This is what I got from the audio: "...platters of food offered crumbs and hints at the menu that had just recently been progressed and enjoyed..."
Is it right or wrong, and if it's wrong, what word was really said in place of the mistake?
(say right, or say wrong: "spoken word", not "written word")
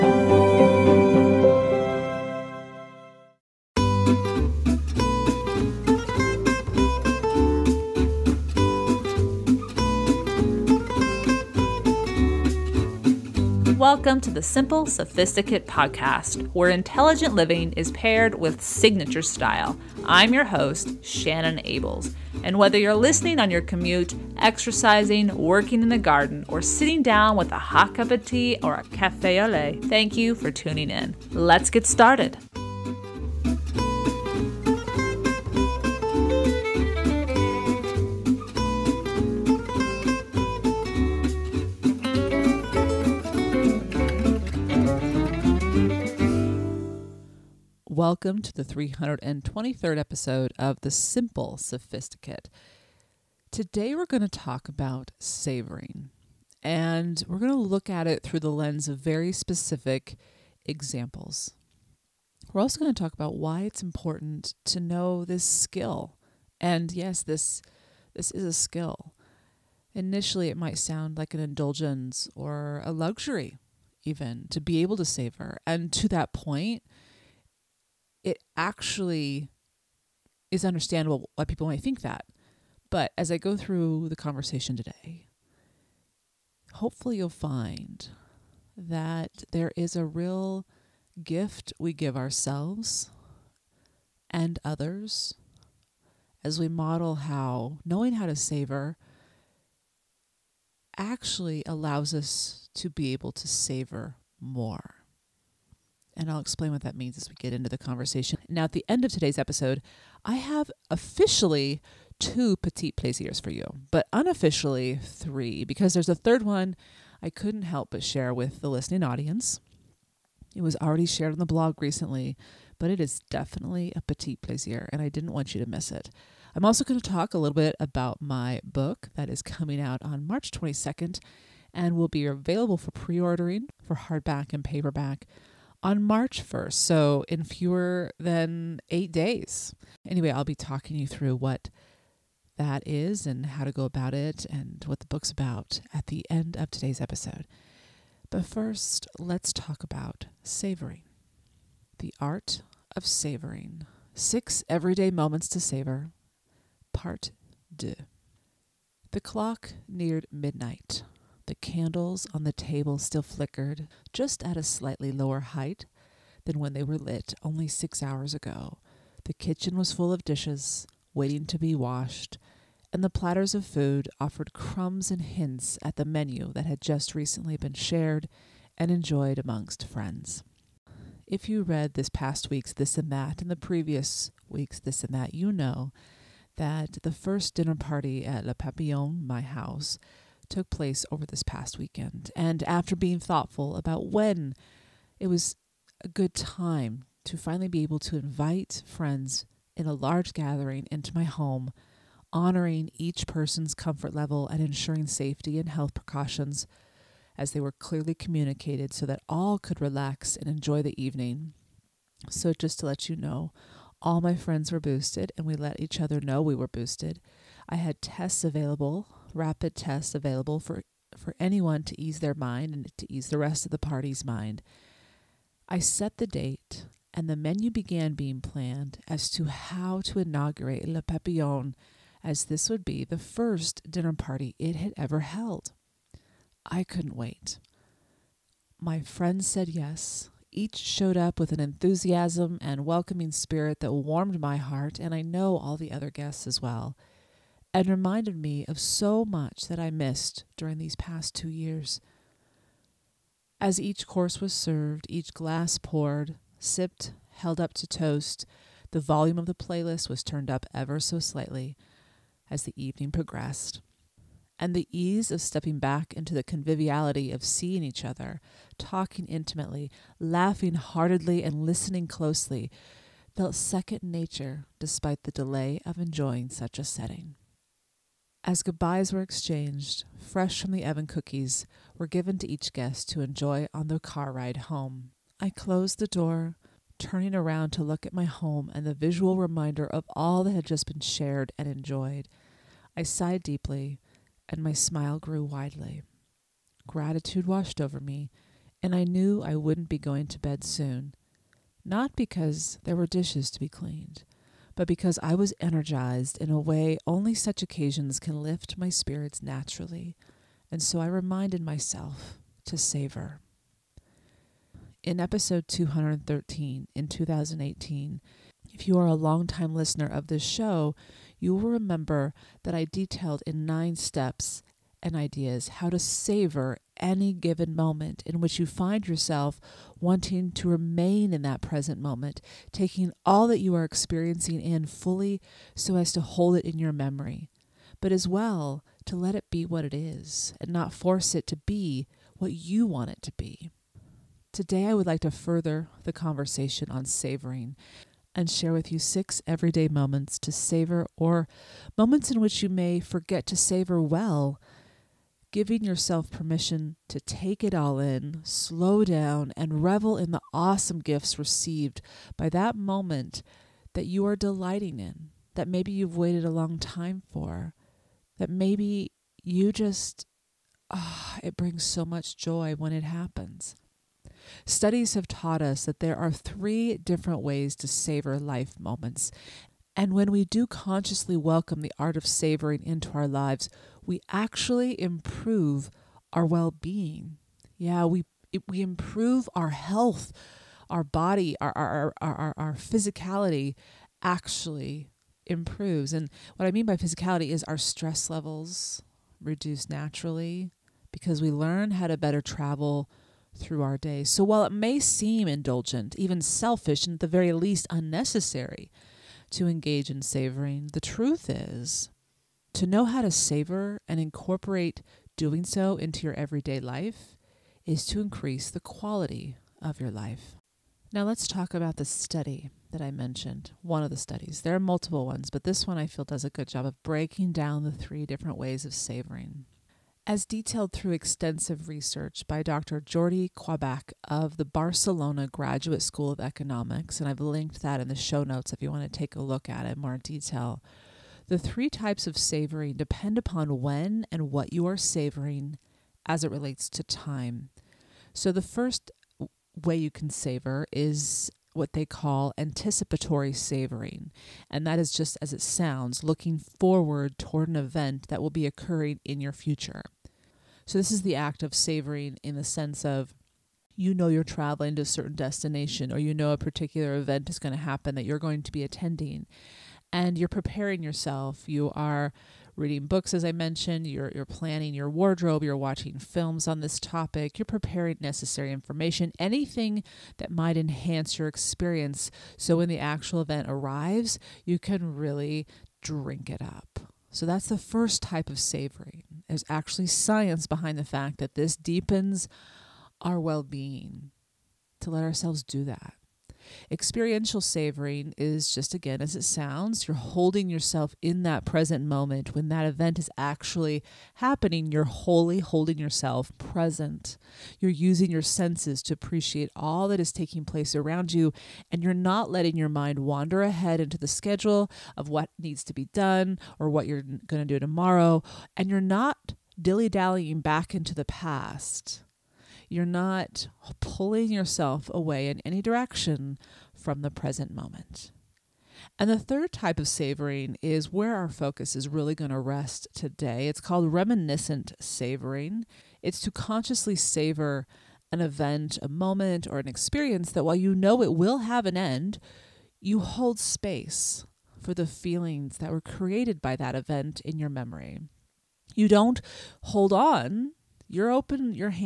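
wrong: "shared", not "progressed".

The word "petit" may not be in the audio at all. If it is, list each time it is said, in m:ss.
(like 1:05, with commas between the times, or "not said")
1:52, 2:04.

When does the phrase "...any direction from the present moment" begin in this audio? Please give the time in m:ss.
8:45.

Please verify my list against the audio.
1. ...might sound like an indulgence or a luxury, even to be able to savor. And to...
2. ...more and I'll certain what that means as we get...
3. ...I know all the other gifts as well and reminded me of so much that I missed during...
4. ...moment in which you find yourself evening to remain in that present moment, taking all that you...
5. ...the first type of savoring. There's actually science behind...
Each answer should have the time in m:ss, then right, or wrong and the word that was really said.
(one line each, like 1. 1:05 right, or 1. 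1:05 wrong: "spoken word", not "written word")
1. 1:10 right
2. 1:44 wrong: "explain", not "certain"
3. 4:05 wrong: "guests", not "gifts"
4. 5:27 wrong: "wanting", not "evening"
5. 8:07 right.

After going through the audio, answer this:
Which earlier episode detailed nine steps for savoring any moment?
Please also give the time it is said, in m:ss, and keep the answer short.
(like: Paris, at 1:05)
213, at 5:15.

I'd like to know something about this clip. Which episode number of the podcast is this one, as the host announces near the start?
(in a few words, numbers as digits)
323rd.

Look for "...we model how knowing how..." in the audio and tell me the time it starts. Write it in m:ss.
1:36.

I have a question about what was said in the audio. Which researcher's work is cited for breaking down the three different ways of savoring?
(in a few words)
Jordi Quoidbach.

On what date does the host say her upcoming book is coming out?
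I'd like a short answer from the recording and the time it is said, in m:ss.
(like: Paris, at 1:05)
March 22nd, at 2:10.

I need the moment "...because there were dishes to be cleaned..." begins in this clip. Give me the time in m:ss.
5:02.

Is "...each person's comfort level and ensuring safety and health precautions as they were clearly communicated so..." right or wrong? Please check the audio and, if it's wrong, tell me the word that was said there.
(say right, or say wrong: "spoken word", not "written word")
right.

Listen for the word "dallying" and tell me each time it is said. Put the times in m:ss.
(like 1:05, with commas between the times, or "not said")
8:40.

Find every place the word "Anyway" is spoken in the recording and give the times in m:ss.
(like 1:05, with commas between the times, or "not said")
2:20.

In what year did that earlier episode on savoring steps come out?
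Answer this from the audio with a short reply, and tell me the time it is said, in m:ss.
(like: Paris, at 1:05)
2018, at 5:17.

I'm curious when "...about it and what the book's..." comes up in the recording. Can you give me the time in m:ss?
2:23.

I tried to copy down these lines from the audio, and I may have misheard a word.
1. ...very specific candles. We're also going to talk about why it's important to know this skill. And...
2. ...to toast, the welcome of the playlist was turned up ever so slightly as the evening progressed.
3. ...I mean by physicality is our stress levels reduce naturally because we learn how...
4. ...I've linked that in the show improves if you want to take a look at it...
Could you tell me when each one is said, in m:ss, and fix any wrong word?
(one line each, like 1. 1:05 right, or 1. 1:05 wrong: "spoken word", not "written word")
1. 0:58 wrong: "examples", not "candles"
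2. 4:17 wrong: "volume", not "welcome"
3. 6:36 right
4. 7:17 wrong: "notes", not "improves".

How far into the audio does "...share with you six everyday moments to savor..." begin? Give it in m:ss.
5:48.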